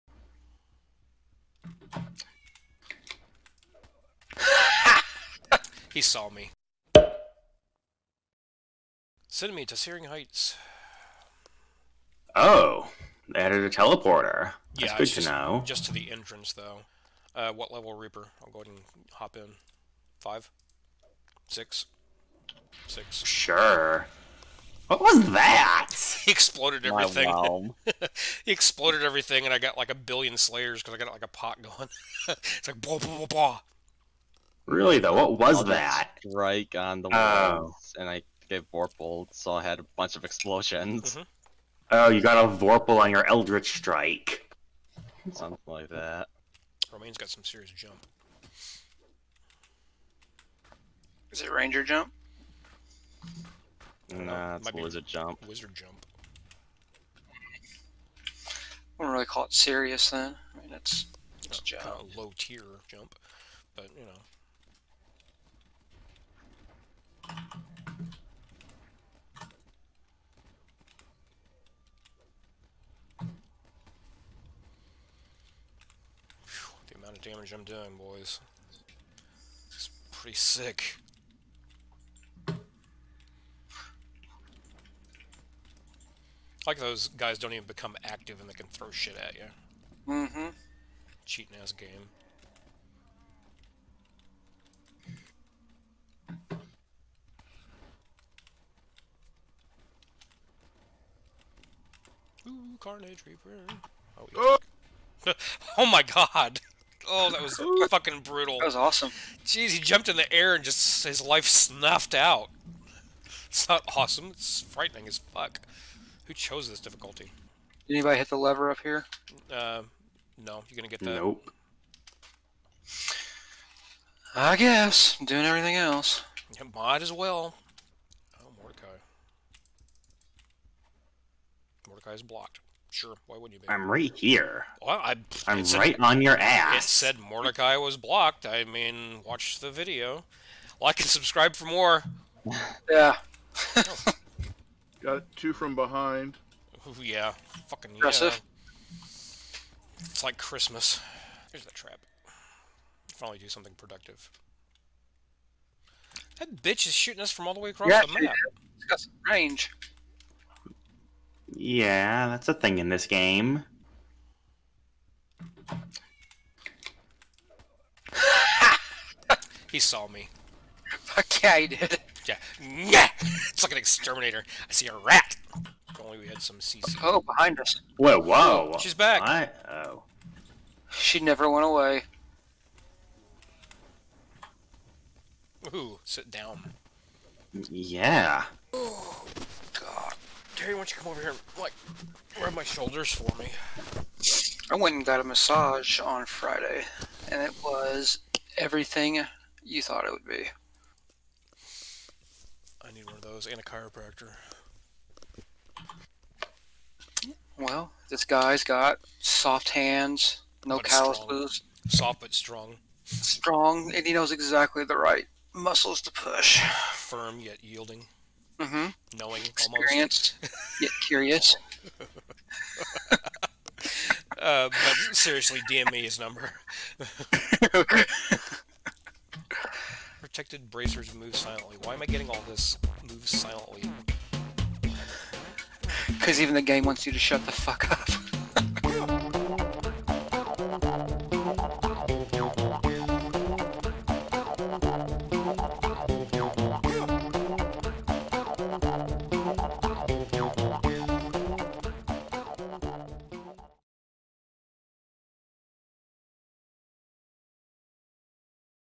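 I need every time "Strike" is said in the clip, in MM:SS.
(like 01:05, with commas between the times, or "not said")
00:36, 00:43.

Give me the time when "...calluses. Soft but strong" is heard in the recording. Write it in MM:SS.
03:30.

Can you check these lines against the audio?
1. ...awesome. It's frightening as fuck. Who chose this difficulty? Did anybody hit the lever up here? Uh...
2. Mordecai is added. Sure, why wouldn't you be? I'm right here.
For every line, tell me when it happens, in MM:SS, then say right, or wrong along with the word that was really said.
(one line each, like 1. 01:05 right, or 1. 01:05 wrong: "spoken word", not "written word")
1. 01:53 right
2. 02:11 wrong: "blocked", not "added".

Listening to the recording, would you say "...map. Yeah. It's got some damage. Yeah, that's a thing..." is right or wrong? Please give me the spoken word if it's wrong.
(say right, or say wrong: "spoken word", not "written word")
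wrong: "range", not "damage".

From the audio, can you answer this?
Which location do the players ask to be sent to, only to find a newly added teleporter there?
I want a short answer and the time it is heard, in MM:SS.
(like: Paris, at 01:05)
Searing Heights, at 00:09.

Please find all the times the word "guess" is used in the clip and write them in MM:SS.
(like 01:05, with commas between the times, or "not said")
02:04.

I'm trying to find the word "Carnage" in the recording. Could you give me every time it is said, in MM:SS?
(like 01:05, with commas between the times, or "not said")
01:42.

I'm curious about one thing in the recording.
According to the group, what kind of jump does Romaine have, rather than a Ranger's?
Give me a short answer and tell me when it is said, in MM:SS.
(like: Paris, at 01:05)
Might Wizard jump, at 00:54.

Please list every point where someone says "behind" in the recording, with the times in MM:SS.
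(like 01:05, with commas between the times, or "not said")
02:25, 02:57.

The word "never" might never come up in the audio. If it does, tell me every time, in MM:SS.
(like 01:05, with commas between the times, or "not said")
03:01.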